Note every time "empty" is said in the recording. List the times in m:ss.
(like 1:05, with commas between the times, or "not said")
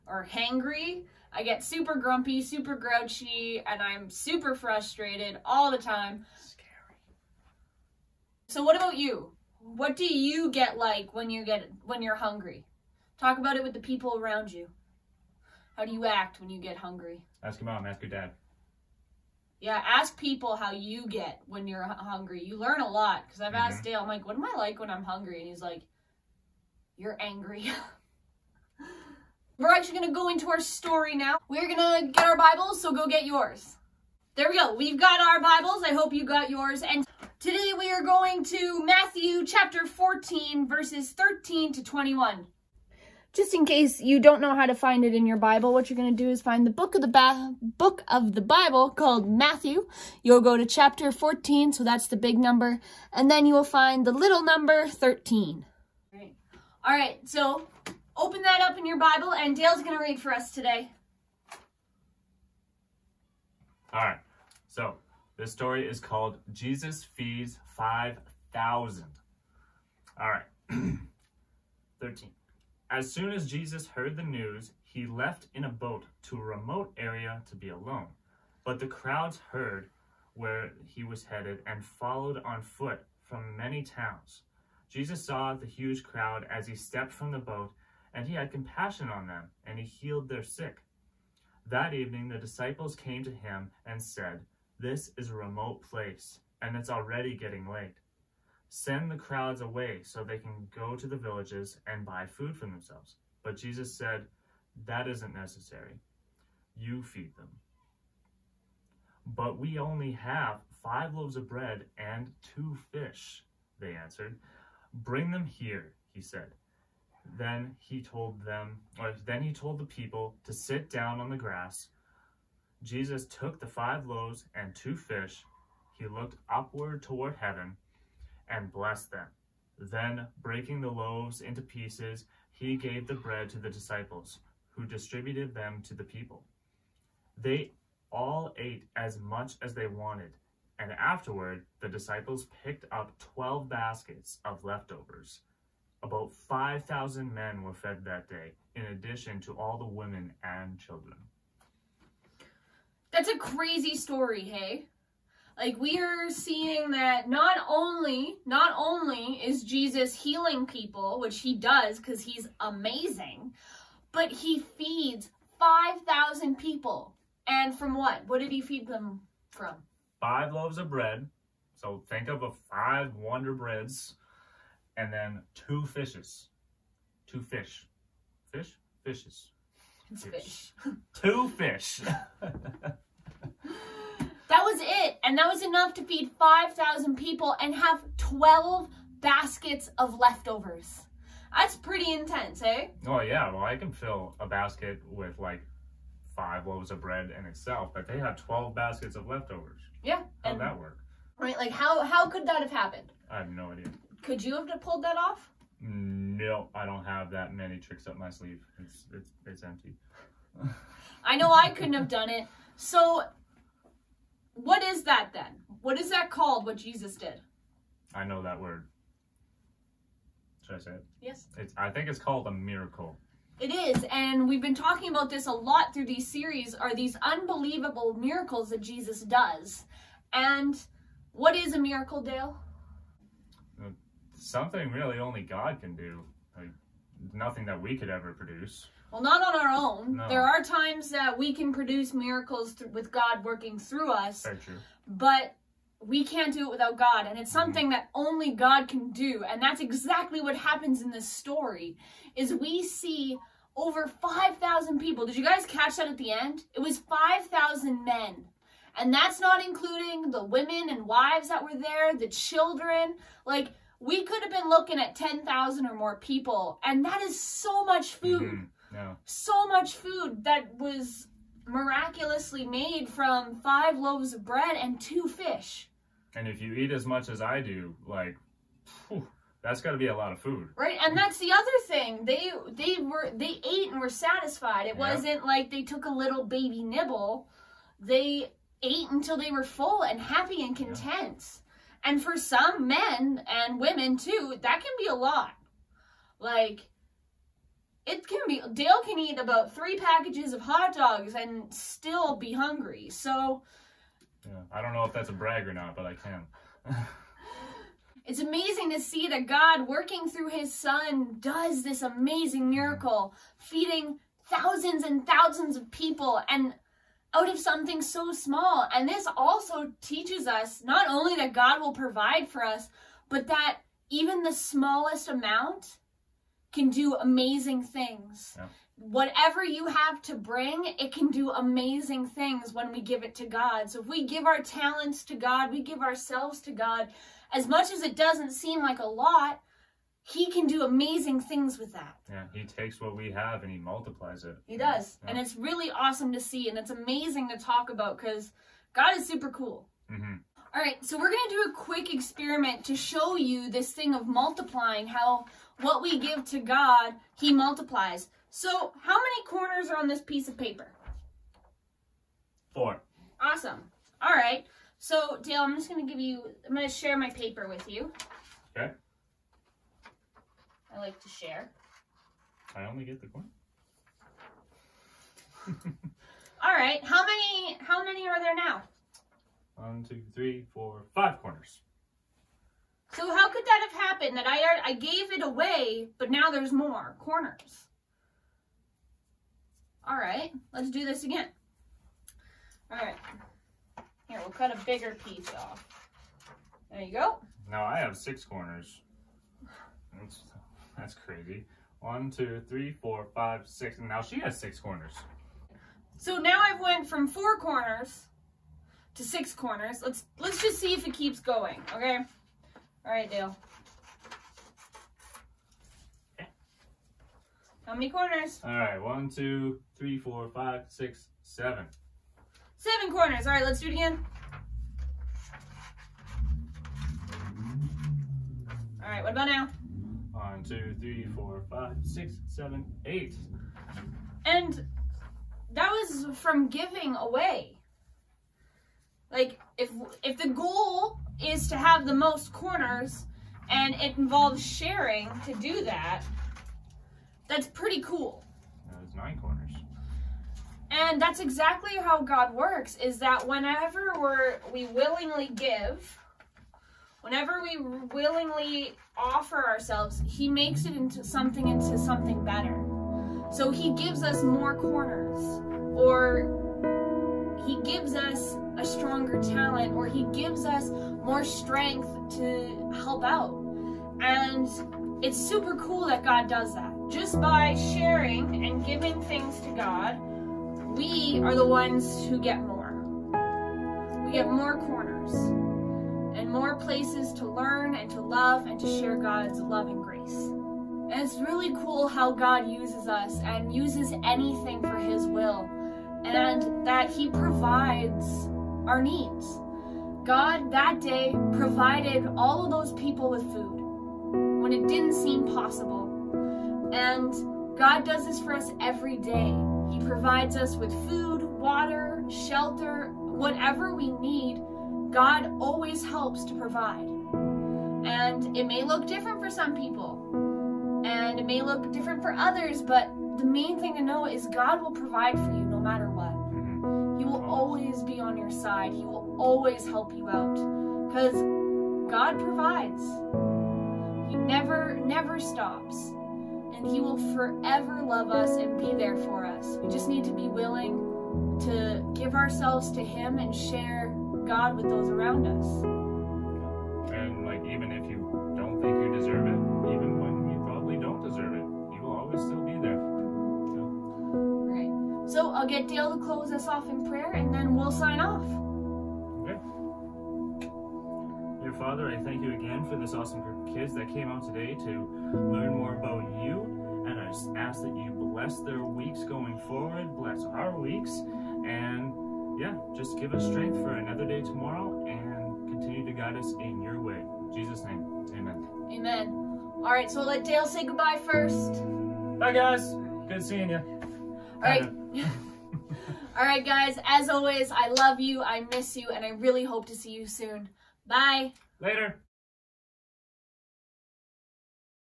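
3:29.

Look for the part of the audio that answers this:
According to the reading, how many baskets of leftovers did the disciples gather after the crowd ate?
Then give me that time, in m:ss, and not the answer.
2:23.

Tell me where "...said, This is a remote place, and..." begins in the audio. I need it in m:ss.
1:34.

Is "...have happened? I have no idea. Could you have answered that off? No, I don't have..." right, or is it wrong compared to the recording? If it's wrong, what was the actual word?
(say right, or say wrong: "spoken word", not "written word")
wrong: "pulled", not "answered".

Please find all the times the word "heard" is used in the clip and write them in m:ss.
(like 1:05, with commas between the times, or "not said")
1:13, 1:19.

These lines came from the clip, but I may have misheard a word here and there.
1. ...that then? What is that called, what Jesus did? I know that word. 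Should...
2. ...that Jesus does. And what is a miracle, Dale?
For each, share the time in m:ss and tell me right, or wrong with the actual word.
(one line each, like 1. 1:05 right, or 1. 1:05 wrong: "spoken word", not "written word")
1. 3:35 right
2. 3:48 right.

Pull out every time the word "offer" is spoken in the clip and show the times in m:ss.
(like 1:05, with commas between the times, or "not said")
7:39.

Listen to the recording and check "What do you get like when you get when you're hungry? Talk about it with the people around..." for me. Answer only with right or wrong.
right.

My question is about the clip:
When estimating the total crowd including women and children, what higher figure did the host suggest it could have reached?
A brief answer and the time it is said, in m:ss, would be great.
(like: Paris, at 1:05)
10,000, at 4:25.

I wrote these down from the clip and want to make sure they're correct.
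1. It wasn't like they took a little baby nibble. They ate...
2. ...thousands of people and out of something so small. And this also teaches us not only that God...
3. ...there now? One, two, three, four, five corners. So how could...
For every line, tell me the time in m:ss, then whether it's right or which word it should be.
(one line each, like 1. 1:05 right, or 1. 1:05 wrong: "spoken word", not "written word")
1. 4:44 right
2. 5:15 right
3. 6:18 right.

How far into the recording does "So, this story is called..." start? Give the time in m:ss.
1:04.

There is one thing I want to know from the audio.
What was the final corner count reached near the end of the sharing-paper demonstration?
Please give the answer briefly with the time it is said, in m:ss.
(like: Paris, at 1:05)
9, at 7:29.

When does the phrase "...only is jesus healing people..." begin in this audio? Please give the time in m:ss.
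2:38.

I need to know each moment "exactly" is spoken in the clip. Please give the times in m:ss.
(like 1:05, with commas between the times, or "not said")
4:09, 7:31.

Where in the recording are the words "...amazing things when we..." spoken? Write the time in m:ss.
5:31.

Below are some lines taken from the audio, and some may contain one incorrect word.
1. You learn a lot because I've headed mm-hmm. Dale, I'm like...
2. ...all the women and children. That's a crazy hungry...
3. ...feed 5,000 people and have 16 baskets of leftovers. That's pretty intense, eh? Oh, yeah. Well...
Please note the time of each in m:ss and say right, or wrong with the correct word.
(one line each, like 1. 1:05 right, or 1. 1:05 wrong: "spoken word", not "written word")
1. 0:22 wrong: "asked", not "headed"
2. 2:29 wrong: "story", not "hungry"
3. 3:06 wrong: "12", not "16".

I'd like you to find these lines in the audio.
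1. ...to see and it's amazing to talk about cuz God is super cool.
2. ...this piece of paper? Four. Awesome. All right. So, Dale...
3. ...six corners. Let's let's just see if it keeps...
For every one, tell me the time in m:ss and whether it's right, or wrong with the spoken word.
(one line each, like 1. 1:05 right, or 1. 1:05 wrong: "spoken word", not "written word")
1. 5:46 right
2. 6:00 right
3. 6:49 right.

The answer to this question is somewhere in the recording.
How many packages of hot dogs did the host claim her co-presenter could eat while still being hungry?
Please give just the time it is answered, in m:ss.
4:59.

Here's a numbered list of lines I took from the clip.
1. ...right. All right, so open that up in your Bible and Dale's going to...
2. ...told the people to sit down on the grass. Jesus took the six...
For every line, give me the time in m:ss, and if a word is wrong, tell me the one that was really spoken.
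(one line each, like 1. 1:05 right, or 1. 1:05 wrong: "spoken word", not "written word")
1. 0:56 right
2. 1:59 wrong: "five", not "six".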